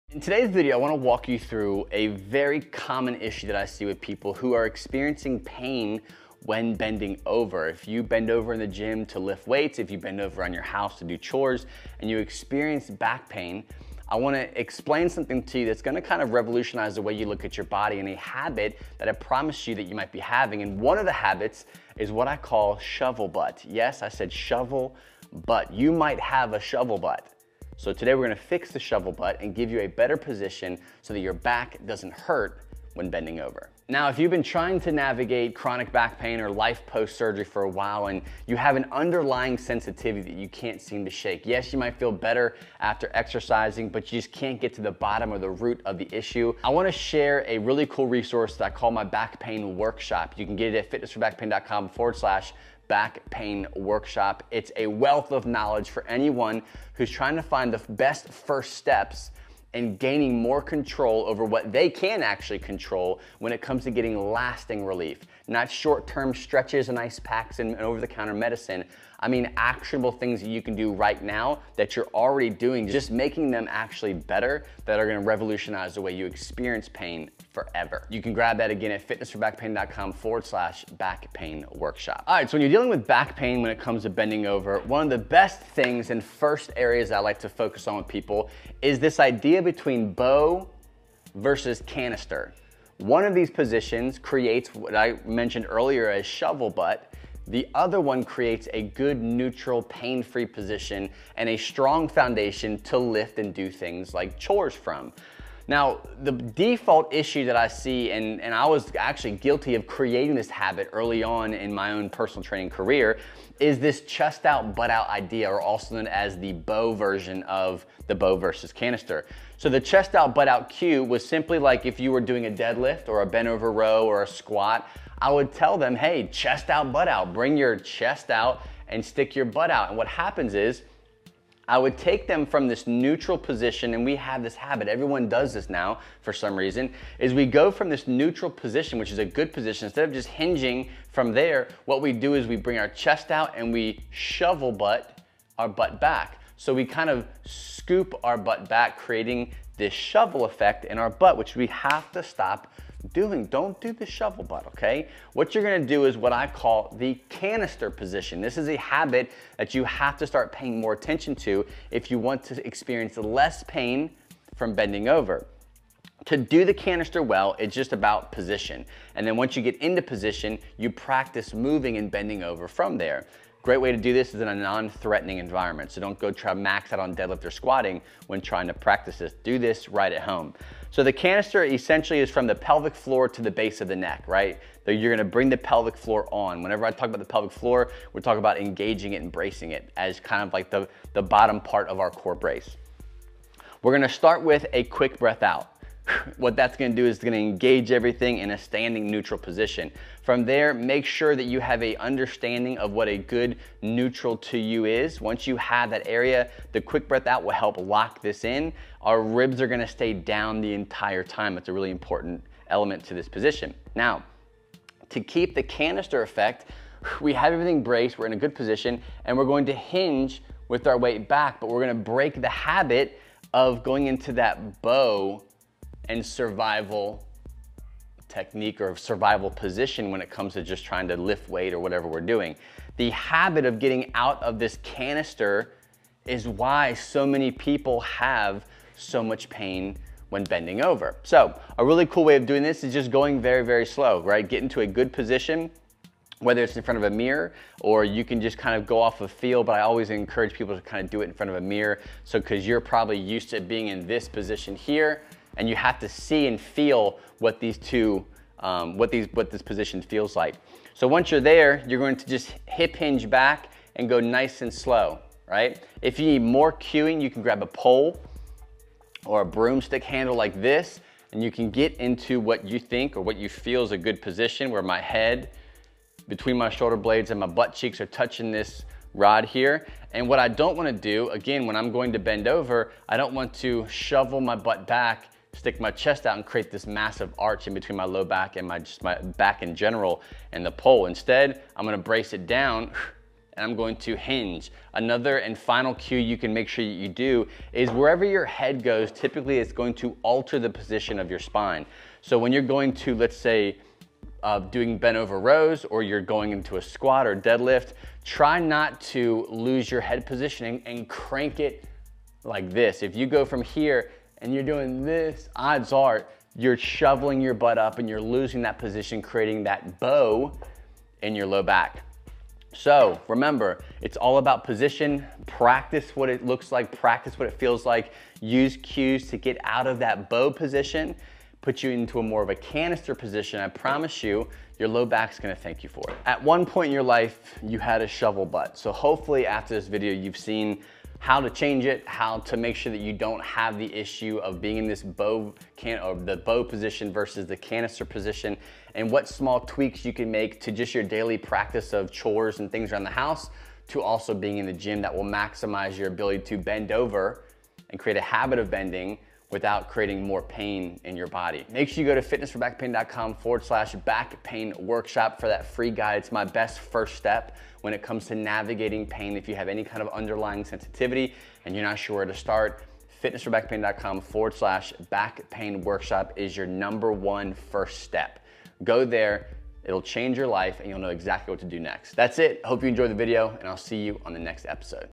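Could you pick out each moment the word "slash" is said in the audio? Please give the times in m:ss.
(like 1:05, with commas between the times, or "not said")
0:52, 1:20, 6:03, 6:14.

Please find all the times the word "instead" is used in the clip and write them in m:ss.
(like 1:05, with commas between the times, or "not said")
2:19, 4:51.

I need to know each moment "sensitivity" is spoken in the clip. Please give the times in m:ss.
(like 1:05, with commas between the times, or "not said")
0:39, 6:10.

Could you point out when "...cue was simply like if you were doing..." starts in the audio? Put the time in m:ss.
2:00.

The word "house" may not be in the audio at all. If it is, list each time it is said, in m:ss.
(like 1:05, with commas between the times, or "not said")
0:10, 5:53.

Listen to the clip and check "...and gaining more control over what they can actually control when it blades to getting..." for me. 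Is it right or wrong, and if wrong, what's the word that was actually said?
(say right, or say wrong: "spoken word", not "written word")
wrong: "comes", not "blades".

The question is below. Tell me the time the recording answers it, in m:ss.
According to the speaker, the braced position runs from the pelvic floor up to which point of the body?
3:03.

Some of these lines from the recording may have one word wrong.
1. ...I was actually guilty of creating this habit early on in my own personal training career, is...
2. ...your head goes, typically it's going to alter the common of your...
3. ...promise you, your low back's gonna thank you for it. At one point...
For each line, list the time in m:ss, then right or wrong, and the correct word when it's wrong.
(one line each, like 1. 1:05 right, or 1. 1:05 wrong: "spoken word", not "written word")
1. 1:48 right
2. 4:58 wrong: "position", not "common"
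3. 5:33 right.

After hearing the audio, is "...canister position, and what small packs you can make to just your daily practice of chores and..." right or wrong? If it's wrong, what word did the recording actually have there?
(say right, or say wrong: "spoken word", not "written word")
wrong: "tweaks", not "packs".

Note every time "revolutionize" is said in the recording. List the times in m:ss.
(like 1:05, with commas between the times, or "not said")
0:16, 1:15.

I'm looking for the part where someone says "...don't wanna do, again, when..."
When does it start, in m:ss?
4:40.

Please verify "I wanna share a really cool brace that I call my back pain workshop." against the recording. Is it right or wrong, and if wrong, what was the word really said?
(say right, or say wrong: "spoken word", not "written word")
wrong: "resource", not "brace".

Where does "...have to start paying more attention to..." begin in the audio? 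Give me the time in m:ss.
2:39.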